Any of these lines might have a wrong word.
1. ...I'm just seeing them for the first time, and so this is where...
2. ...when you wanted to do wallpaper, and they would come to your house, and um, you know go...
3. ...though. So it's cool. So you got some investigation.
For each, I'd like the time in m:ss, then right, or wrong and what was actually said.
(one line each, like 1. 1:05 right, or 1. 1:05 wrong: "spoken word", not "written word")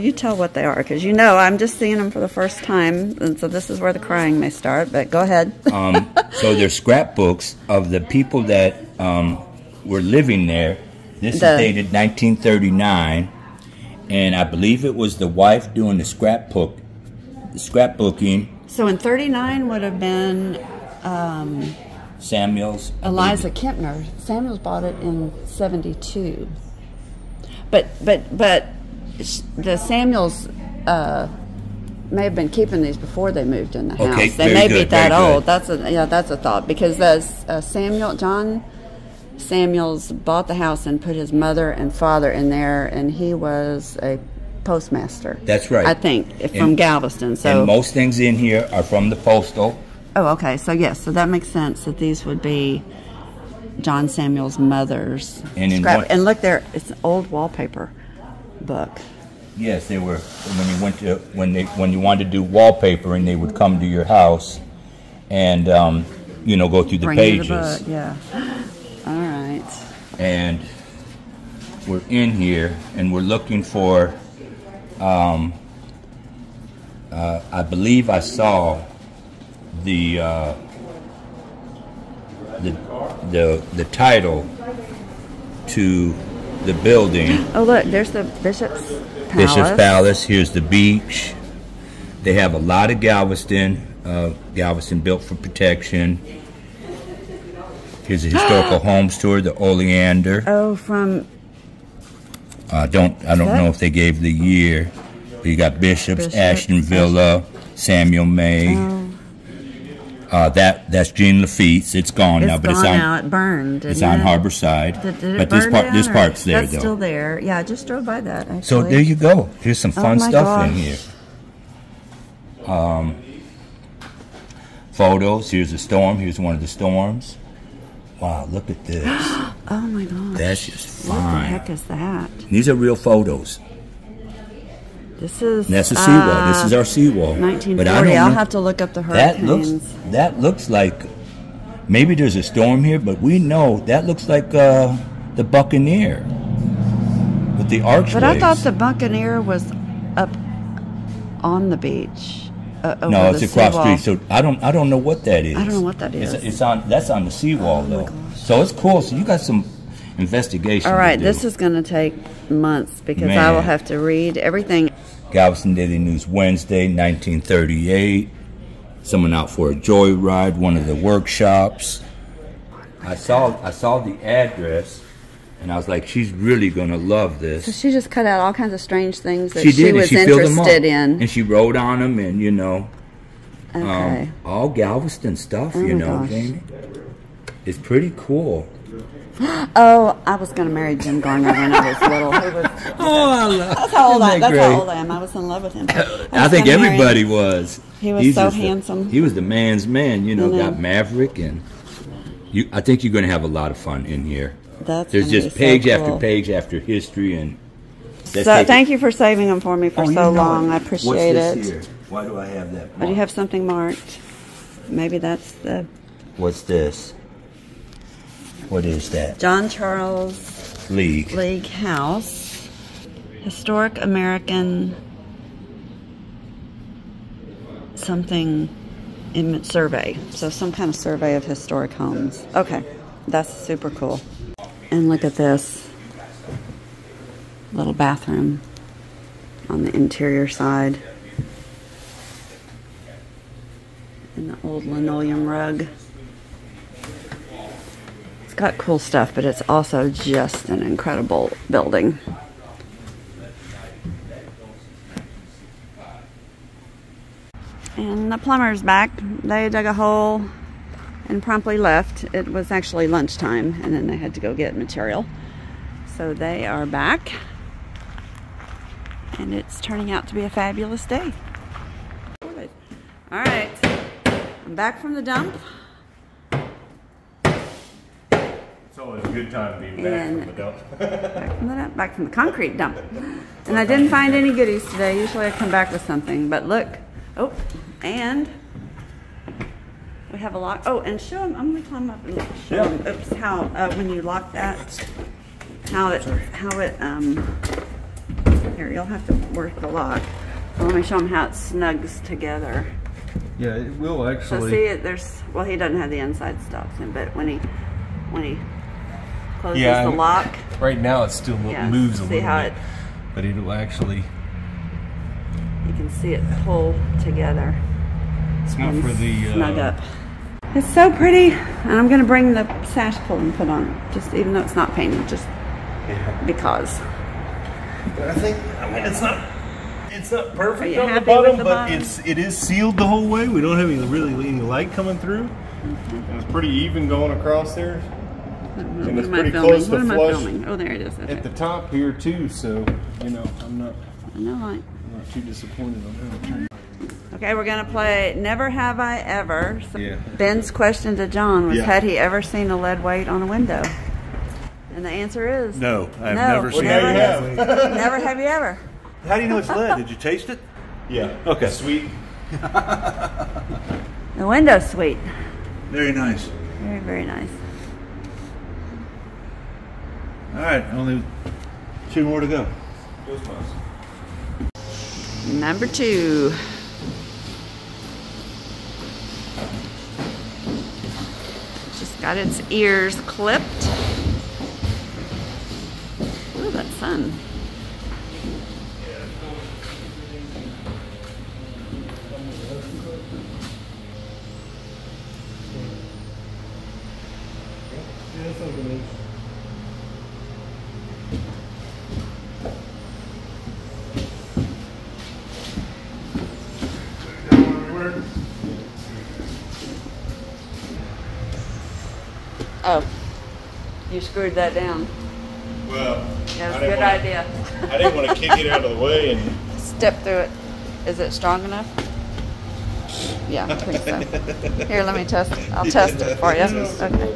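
1. 0:01 right
2. 1:01 right
3. 2:38 right.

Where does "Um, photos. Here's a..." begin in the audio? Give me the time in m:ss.
2:02.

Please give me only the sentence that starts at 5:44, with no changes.
No I'm not too disappointed on that.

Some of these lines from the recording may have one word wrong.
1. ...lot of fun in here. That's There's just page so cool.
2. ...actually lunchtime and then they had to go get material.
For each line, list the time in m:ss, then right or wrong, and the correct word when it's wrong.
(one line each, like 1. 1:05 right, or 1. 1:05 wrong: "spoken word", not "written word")
1. 3:23 right
2. 4:22 right.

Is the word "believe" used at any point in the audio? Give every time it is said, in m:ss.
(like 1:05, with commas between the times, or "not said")
0:14, 1:17.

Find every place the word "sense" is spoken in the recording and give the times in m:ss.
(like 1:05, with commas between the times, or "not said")
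0:51.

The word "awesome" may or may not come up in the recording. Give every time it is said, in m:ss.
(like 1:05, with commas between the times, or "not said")
not said.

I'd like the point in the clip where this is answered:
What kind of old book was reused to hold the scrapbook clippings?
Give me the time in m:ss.
0:57.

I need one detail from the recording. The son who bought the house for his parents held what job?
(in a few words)
Postmaster.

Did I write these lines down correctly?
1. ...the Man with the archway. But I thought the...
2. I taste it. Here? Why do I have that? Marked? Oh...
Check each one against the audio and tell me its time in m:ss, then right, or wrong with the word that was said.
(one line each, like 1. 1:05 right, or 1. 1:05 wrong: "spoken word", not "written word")
1. 2:25 wrong: "Buccaneer", not "Man"
2. 3:30 wrong: "appreciate", not "taste".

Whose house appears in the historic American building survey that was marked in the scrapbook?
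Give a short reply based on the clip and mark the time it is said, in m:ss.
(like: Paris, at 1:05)
John Charles League, at 3:39.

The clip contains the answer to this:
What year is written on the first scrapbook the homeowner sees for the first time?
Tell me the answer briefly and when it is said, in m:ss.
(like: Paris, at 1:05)
1939, at 0:11.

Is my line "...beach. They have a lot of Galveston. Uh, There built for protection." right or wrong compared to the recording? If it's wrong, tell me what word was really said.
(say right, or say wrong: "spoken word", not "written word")
wrong: "Galveston", not "There".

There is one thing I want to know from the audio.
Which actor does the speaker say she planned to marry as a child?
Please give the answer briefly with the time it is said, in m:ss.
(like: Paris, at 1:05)
Jim Garner, at 3:10.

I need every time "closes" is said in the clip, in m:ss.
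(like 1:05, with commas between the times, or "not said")
5:09, 5:39.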